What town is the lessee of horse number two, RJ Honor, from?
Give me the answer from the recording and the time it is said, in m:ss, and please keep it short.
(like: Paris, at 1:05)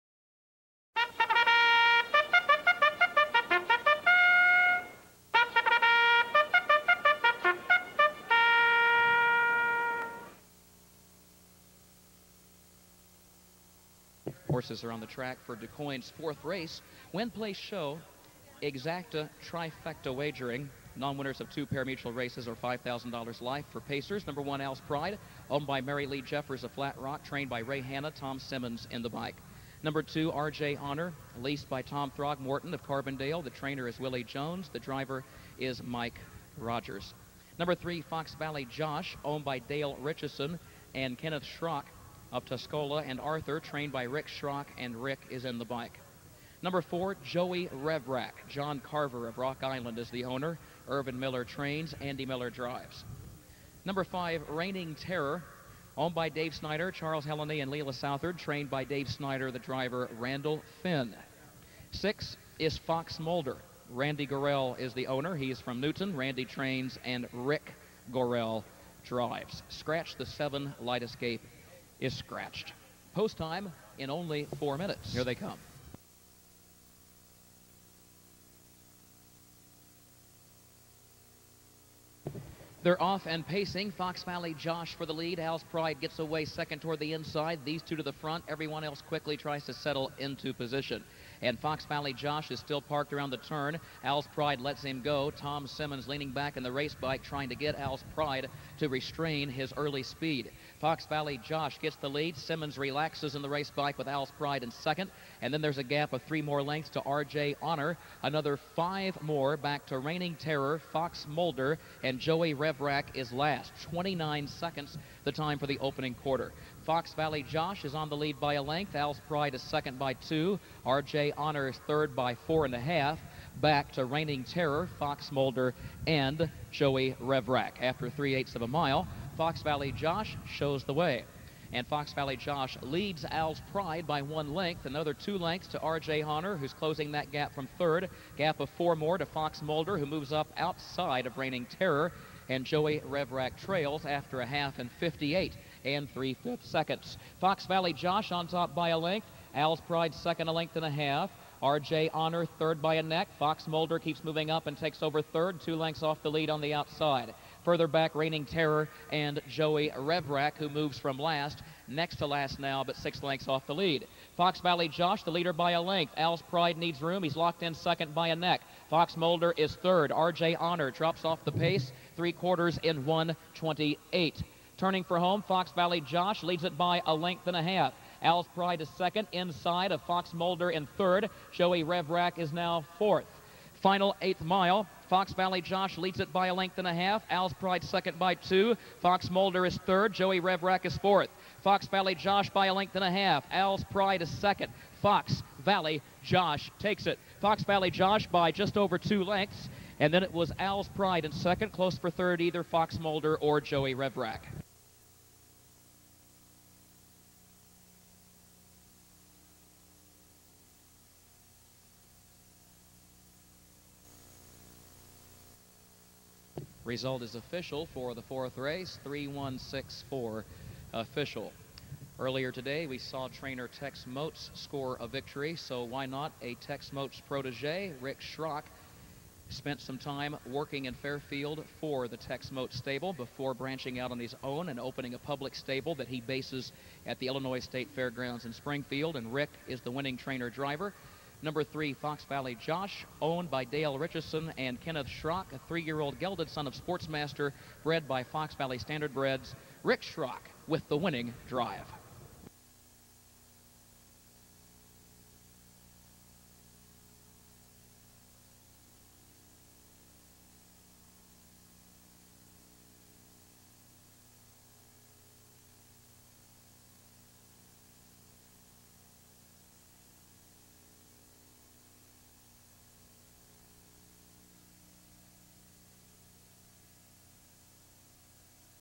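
Carbondale, at 0:32.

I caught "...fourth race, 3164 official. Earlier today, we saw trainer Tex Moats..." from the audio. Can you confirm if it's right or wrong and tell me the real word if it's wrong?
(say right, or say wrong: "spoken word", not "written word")
right.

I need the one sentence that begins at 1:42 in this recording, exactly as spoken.
Simmons relaxes in the race bike with Al's Pride in second.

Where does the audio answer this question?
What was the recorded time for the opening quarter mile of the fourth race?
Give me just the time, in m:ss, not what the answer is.
1:53.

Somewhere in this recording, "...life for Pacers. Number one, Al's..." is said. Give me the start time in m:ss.
0:23.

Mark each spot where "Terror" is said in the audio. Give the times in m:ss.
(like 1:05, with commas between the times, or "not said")
0:54, 1:50, 2:04, 2:21, 2:38.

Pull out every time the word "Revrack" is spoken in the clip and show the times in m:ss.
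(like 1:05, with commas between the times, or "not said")
0:47, 2:07, 2:23, 2:39, 3:01, 3:10, 3:23.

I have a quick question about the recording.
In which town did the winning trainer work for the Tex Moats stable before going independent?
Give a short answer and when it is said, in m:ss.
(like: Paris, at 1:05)
Fairfield, at 3:50.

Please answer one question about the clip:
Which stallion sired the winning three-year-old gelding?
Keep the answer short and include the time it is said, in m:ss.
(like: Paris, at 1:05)
Sportsmaster, at 4:06.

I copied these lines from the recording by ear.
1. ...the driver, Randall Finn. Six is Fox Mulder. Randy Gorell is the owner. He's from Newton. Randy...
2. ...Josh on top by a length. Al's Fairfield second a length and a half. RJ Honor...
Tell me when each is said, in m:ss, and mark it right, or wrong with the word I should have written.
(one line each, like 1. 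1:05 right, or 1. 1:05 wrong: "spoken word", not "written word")
1. 0:59 right
2. 2:27 wrong: "Pride", not "Fairfield".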